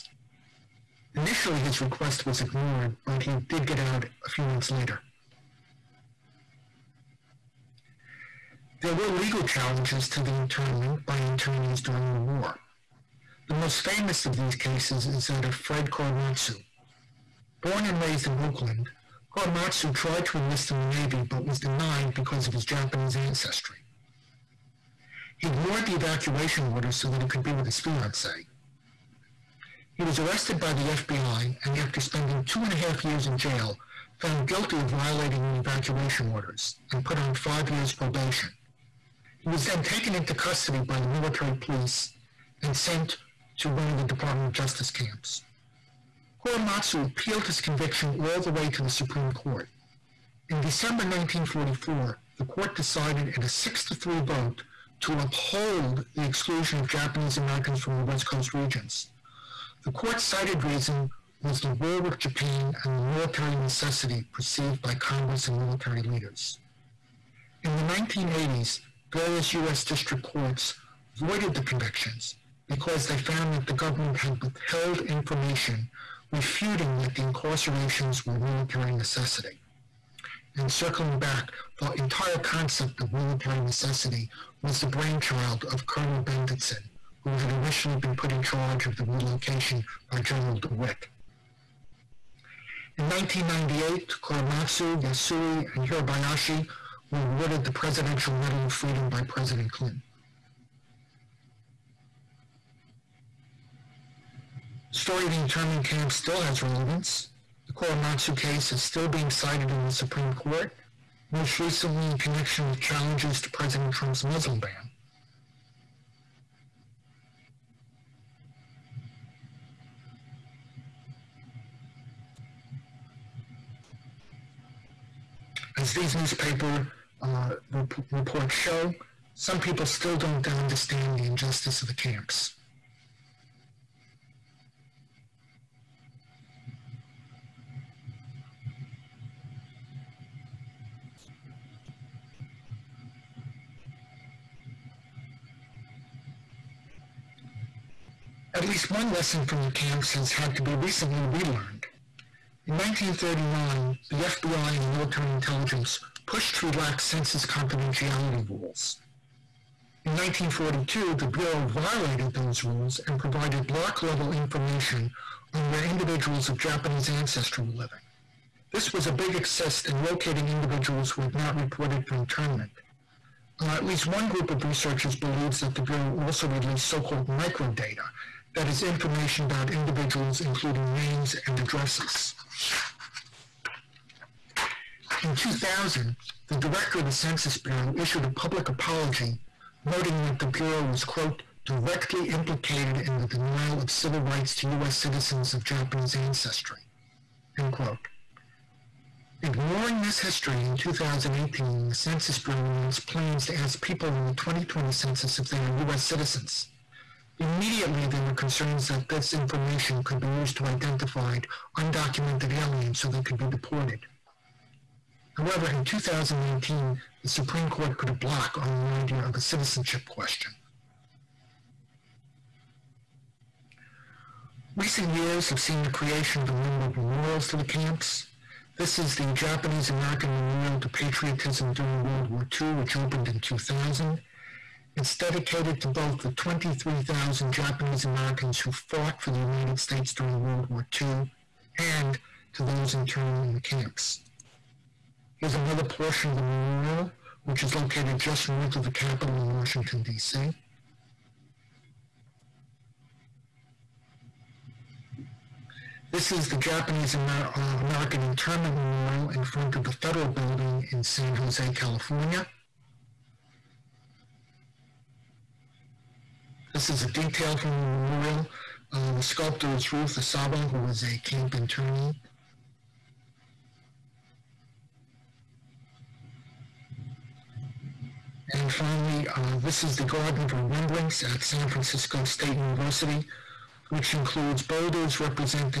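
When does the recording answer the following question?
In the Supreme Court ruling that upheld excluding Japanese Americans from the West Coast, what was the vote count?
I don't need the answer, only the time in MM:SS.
00:53.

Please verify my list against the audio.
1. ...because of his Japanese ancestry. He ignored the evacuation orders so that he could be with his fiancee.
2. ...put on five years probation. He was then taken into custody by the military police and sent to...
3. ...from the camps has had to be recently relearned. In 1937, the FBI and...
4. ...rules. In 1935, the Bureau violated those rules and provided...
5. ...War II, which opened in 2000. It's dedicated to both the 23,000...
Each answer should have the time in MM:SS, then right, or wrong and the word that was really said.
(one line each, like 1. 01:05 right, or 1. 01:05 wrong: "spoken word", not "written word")
1. 00:22 right
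2. 00:37 right
3. 02:29 wrong: "1939", not "1937"
4. 02:38 wrong: "1942", not "1935"
5. 03:52 right.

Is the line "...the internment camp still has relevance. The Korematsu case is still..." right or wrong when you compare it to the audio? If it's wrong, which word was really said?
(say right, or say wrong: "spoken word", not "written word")
right.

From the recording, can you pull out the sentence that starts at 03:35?
However, in 2019, the Supreme Court put a block on the idea of a citizenship question.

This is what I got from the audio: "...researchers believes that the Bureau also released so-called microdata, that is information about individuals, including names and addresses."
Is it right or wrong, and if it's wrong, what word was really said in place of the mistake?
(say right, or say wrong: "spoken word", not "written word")
right.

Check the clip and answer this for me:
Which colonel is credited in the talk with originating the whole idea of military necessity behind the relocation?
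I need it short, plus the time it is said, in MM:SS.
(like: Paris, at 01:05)
Colonel Bendetsen, at 01:25.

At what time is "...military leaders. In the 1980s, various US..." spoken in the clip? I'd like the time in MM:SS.
01:05.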